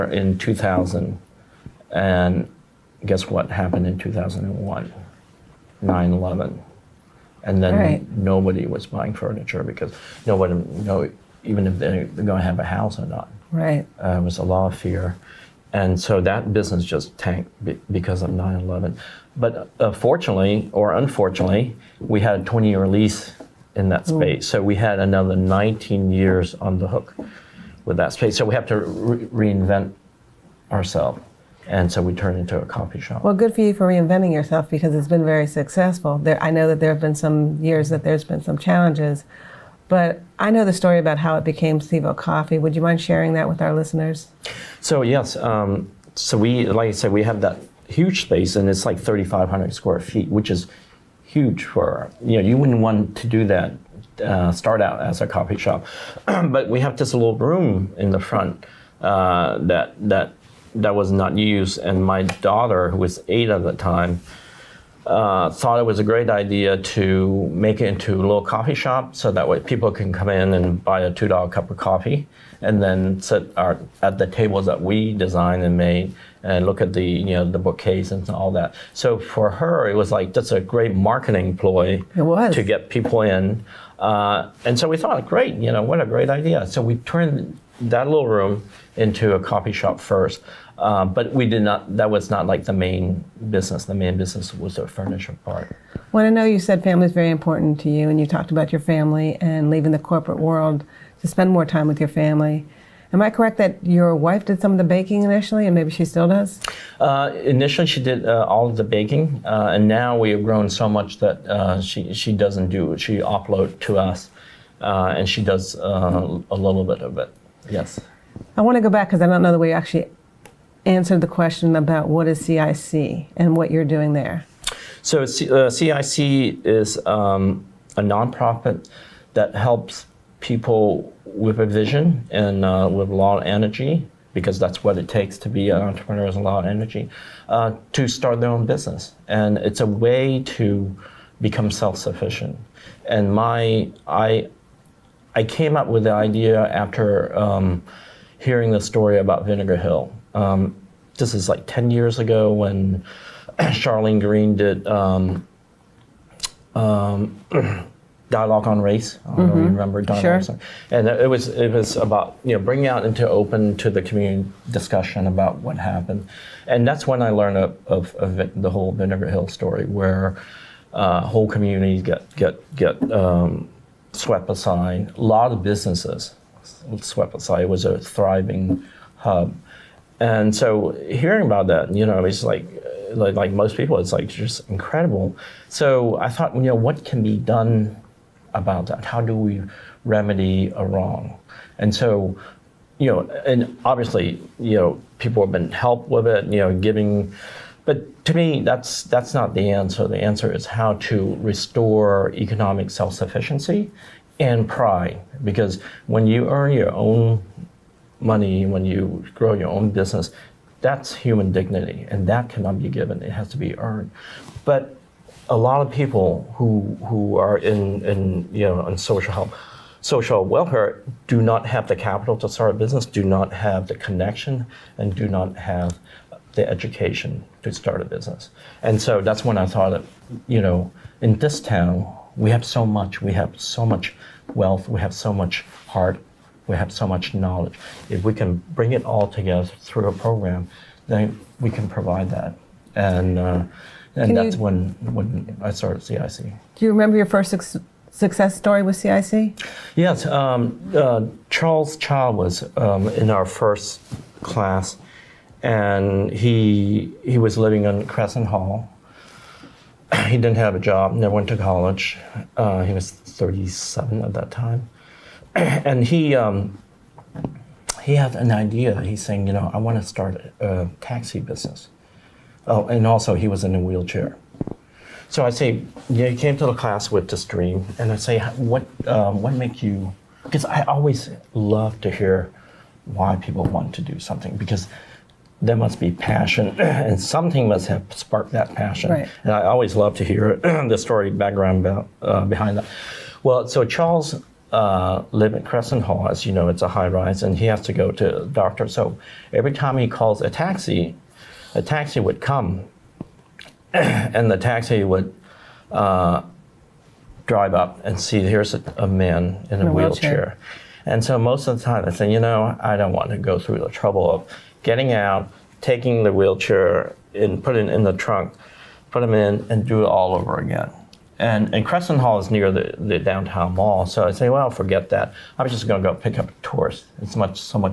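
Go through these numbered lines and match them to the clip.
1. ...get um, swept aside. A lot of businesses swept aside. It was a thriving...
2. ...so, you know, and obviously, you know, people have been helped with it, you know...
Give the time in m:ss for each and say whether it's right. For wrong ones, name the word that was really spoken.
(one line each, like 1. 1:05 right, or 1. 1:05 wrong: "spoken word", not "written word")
1. 2:52 right
2. 3:11 right.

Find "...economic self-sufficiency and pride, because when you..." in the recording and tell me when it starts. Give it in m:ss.
3:22.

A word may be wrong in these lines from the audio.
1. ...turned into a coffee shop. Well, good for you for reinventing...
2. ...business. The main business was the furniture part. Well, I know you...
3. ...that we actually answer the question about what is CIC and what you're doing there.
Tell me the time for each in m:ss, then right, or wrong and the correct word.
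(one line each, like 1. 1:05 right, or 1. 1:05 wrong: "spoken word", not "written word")
1. 0:32 right
2. 1:33 right
3. 1:59 right.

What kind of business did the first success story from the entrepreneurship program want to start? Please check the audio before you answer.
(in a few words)
taxi business.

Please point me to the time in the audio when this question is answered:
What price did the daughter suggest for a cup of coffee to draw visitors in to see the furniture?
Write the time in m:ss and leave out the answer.
1:11.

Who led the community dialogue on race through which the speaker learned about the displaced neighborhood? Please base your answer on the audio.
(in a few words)
Charlene Green.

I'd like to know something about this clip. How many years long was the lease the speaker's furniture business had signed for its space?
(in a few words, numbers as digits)
20 years.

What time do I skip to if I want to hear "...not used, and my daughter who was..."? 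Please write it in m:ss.
1:01.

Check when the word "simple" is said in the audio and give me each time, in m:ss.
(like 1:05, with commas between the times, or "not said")
not said.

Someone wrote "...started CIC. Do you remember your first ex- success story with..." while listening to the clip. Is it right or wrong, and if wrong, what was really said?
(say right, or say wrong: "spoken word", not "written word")
right.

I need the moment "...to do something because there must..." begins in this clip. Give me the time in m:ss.
4:43.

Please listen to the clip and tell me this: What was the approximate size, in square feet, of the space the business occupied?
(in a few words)
3,500.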